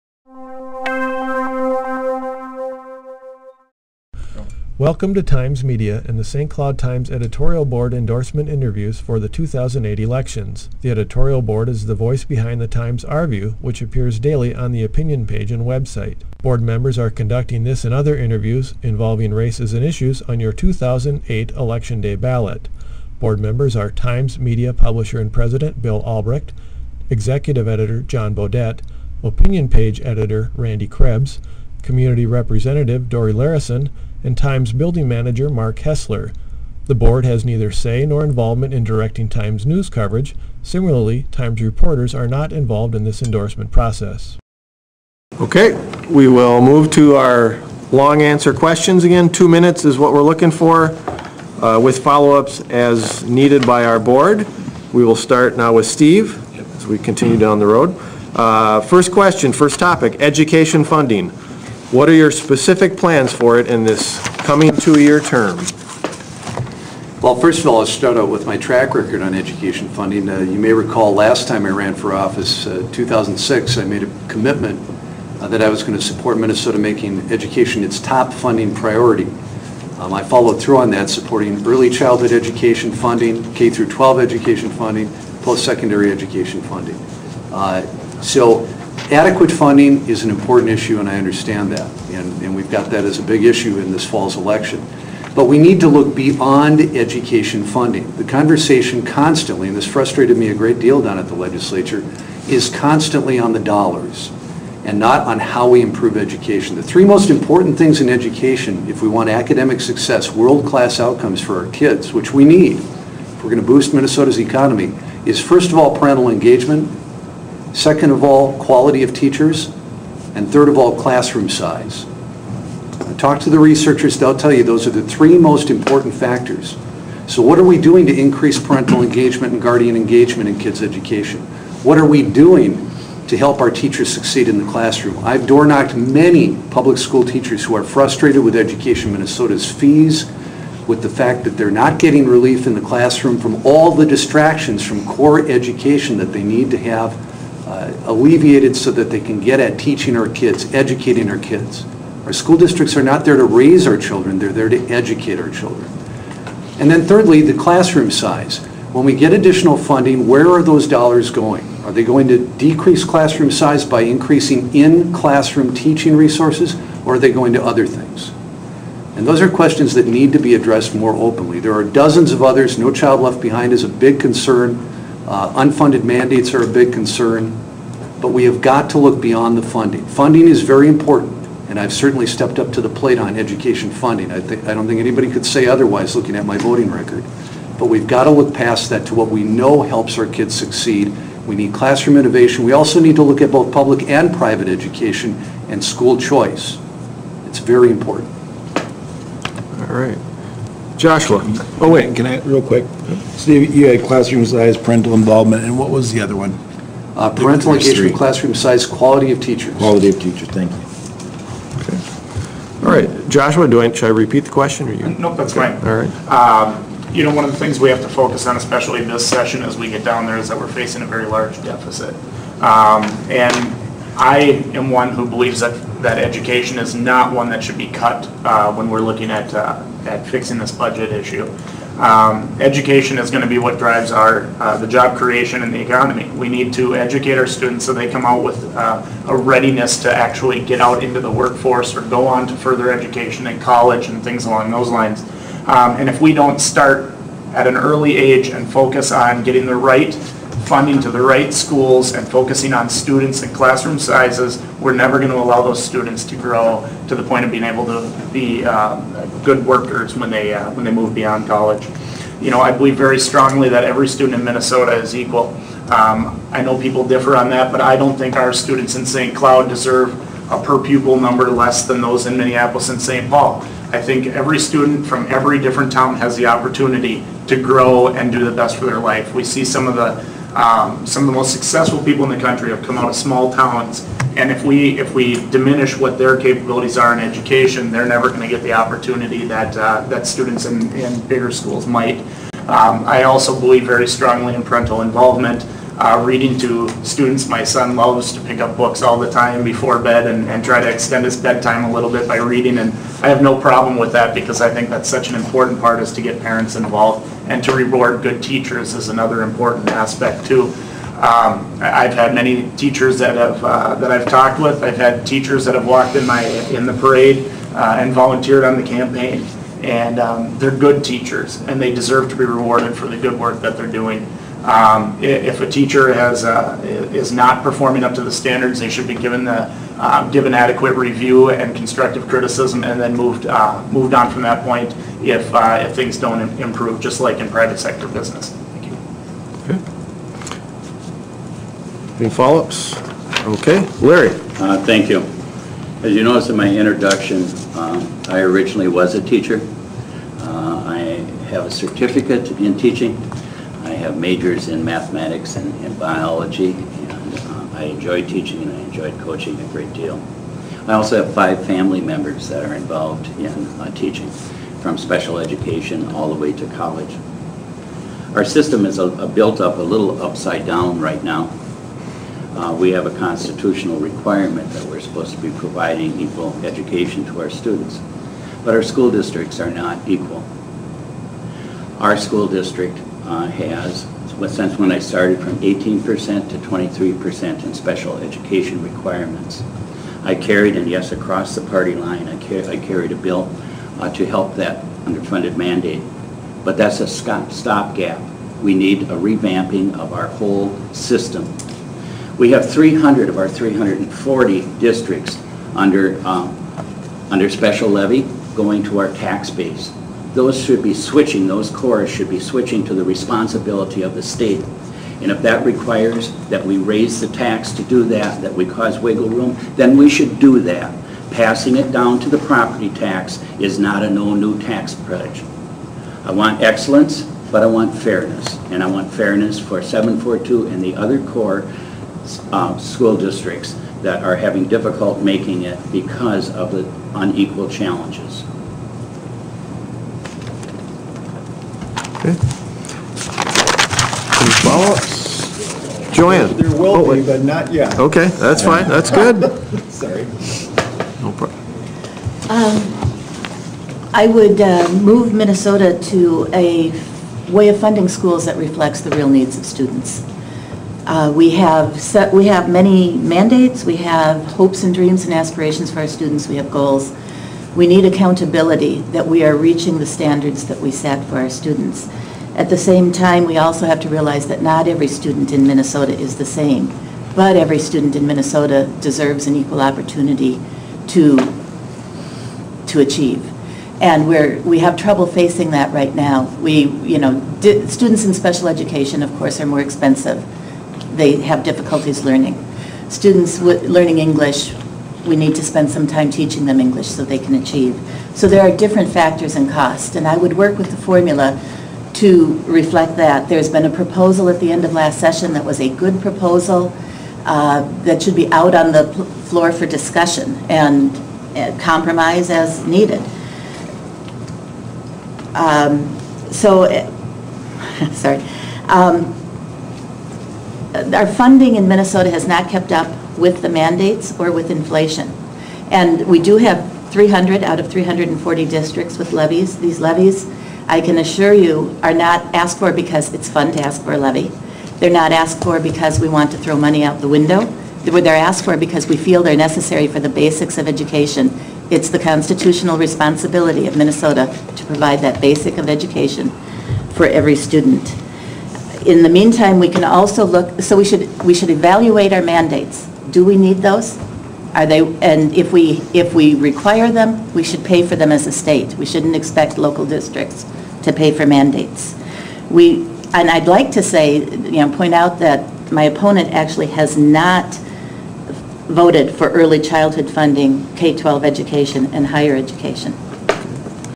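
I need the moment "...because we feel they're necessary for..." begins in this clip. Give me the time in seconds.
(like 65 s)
538 s.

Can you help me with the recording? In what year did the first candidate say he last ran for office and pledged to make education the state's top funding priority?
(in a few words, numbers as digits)
2006.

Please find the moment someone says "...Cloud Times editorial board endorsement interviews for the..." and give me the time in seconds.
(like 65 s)
6 s.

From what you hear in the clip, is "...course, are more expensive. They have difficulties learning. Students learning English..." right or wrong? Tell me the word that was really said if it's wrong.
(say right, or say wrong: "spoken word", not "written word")
right.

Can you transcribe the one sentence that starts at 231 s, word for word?
Um, education is going to be what drives our uh, the job creation and the economy.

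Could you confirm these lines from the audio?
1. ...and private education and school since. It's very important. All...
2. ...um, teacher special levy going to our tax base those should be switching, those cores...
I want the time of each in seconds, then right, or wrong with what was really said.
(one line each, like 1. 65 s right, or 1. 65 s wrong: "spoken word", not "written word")
1. 194 s wrong: "choice", not "since"
2. 406 s wrong: "under", not "teacher".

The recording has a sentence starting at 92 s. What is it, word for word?
And, and we've got that as a big issue in this fall's election.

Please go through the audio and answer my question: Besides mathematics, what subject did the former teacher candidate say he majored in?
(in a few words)
biology.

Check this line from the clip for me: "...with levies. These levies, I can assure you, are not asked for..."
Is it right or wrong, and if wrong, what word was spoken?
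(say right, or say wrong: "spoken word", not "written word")
right.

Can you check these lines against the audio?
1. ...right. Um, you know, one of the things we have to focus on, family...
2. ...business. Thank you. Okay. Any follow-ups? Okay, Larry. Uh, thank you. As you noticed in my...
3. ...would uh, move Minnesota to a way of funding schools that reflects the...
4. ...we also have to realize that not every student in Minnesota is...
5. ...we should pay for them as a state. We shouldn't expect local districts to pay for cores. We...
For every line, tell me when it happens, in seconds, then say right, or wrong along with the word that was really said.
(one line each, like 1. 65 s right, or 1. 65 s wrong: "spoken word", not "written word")
1. 215 s wrong: "especially", not "family"
2. 338 s right
3. 454 s right
4. 473 s right
5. 557 s wrong: "mandates", not "cores".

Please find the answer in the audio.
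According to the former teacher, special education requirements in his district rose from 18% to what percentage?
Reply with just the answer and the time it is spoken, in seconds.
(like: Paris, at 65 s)
23%, at 386 s.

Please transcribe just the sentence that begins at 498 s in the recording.
So there are different factors and cost, and I would work with the formula to reflect that.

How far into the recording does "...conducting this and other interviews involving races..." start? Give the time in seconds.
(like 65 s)
17 s.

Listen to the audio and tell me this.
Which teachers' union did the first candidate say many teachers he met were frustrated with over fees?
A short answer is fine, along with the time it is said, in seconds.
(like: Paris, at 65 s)
Education Minnesota, at 138 s.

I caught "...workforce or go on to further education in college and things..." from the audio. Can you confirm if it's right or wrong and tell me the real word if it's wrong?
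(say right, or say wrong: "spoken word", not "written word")
right.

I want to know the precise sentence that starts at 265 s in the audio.
Um, I know people differ on that, but I don't think our students in St.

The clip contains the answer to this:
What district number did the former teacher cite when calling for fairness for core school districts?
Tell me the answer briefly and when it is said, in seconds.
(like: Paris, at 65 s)
742, at 429 s.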